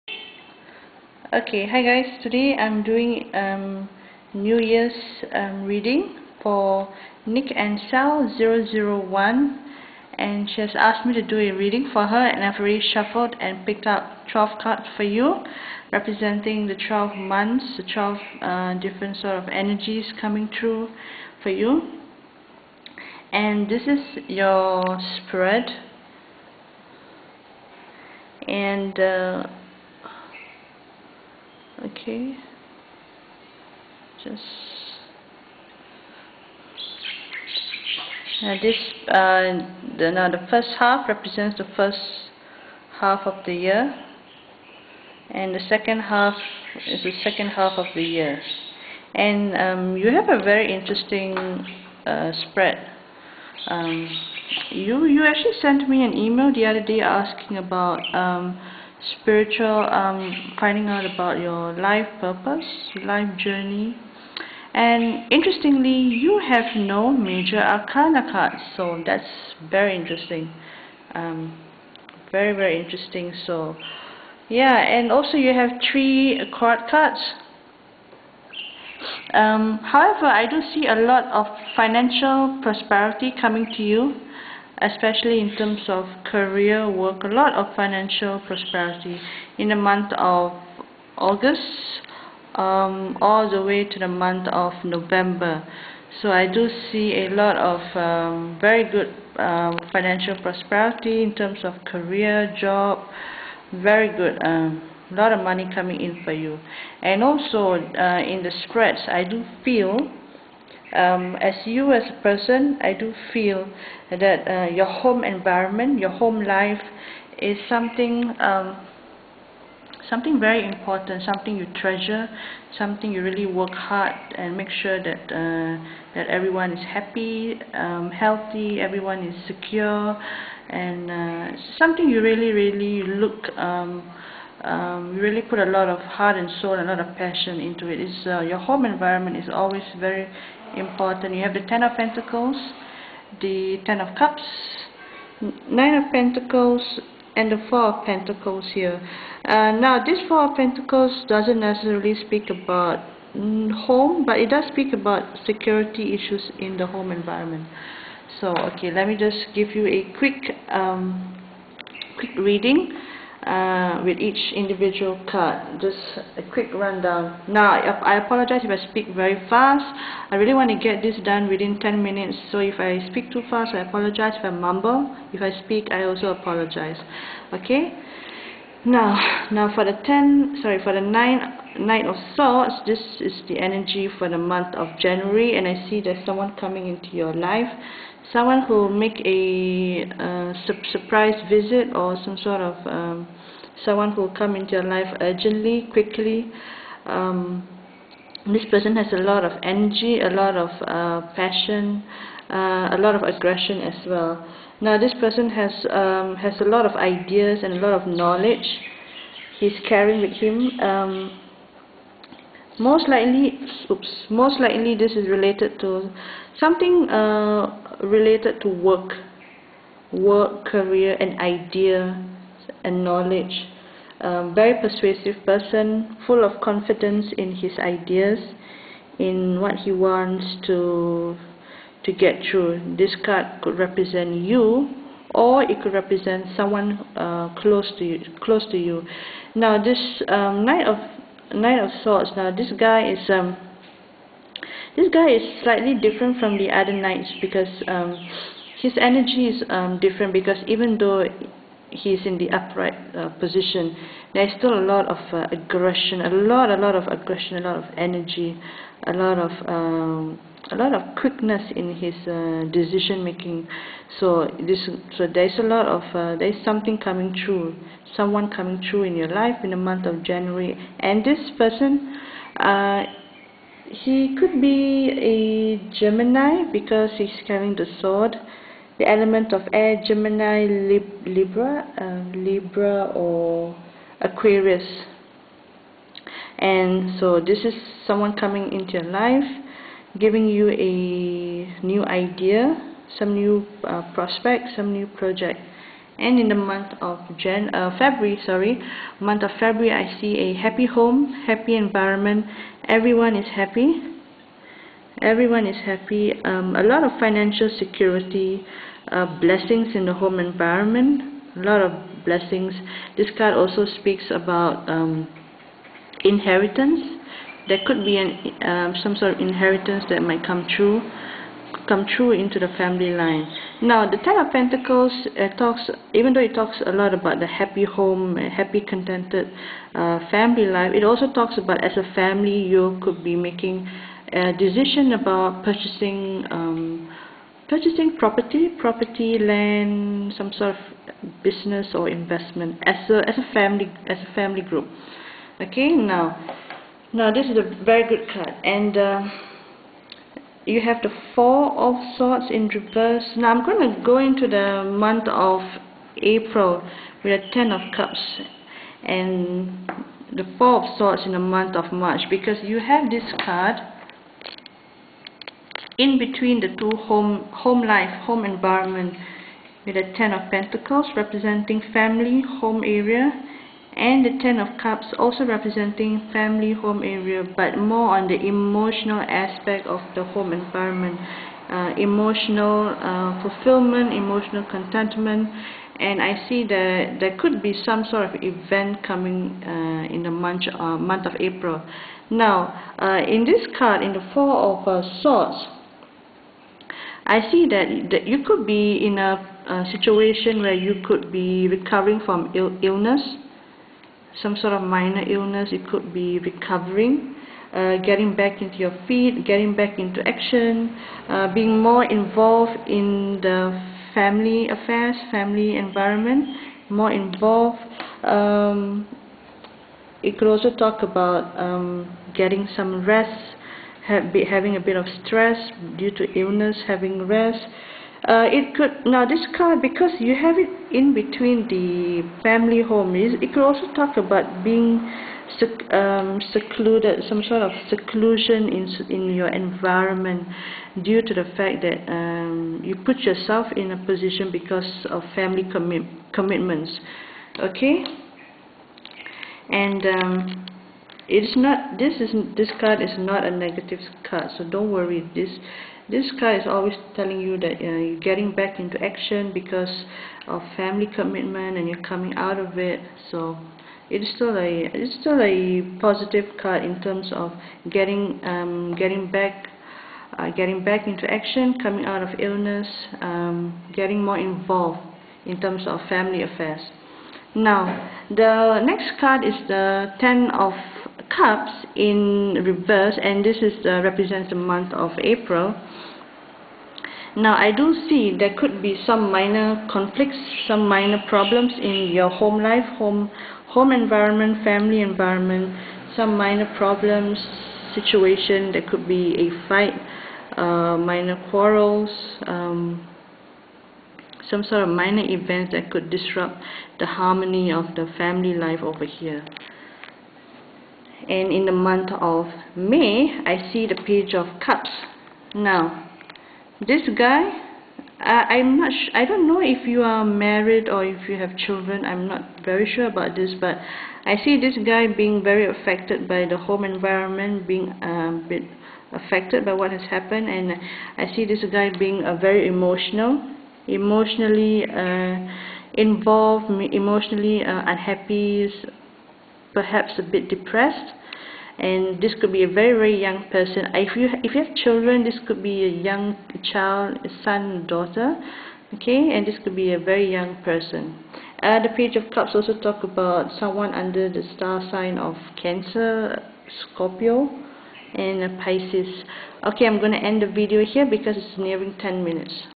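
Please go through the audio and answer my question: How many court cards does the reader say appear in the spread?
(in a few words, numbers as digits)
three.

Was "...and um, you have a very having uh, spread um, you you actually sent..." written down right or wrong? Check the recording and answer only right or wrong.
wrong.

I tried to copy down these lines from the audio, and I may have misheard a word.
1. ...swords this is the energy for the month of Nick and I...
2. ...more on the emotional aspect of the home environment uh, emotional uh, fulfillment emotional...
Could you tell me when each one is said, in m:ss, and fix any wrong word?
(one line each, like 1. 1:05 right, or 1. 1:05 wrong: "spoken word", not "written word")
1. 3:02 wrong: "January", not "Nick"
2. 6:17 right.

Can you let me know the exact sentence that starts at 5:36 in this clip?
Um, purchasing property, property, land, some sort of business or investment as a as a family as a family group.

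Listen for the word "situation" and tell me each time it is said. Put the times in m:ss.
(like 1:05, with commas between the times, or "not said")
6:39, 8:17.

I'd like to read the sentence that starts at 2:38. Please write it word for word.
So, okay, let me just give you a quick, um, quick reading uh, with each individual card.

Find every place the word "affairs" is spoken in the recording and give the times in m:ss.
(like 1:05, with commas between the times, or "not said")
6:54, 7:56.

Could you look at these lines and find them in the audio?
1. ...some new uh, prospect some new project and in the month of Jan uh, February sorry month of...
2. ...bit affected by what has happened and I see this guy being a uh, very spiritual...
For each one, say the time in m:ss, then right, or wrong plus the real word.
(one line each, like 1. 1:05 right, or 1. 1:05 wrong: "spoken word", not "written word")
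1. 4:53 right
2. 8:48 wrong: "emotional", not "spiritual".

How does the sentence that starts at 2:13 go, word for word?
Um, um, you really put a lot of heart and soul, a lot of passion into it.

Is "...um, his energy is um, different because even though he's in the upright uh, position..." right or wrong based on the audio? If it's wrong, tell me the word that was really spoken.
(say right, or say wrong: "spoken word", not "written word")
right.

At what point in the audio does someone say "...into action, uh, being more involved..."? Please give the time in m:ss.
6:49.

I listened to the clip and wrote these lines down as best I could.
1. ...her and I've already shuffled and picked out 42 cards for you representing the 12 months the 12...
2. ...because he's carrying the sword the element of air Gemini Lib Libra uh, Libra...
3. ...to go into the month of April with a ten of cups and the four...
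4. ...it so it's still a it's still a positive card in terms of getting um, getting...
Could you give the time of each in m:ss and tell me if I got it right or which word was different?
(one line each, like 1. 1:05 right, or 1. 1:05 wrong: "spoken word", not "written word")
1. 0:12 wrong: "12", not "42"
2. 4:36 right
3. 5:53 right
4. 7:42 right.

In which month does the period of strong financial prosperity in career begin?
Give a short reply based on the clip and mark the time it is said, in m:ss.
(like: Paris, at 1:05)
August, at 1:31.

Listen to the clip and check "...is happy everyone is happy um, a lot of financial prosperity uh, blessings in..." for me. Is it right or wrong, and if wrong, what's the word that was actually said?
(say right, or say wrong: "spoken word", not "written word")
wrong: "security", not "prosperity".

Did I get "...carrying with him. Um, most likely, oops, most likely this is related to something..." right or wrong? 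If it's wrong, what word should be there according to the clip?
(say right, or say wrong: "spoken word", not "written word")
right.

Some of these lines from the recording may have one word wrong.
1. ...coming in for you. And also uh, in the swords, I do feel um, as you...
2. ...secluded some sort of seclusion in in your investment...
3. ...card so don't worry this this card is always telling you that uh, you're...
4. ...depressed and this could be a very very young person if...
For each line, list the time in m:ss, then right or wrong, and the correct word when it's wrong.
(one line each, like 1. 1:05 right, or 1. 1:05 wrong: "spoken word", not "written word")
1. 1:45 wrong: "spreads", not "swords"
2. 7:16 wrong: "environment", not "investment"
3. 7:34 right
4. 9:00 right.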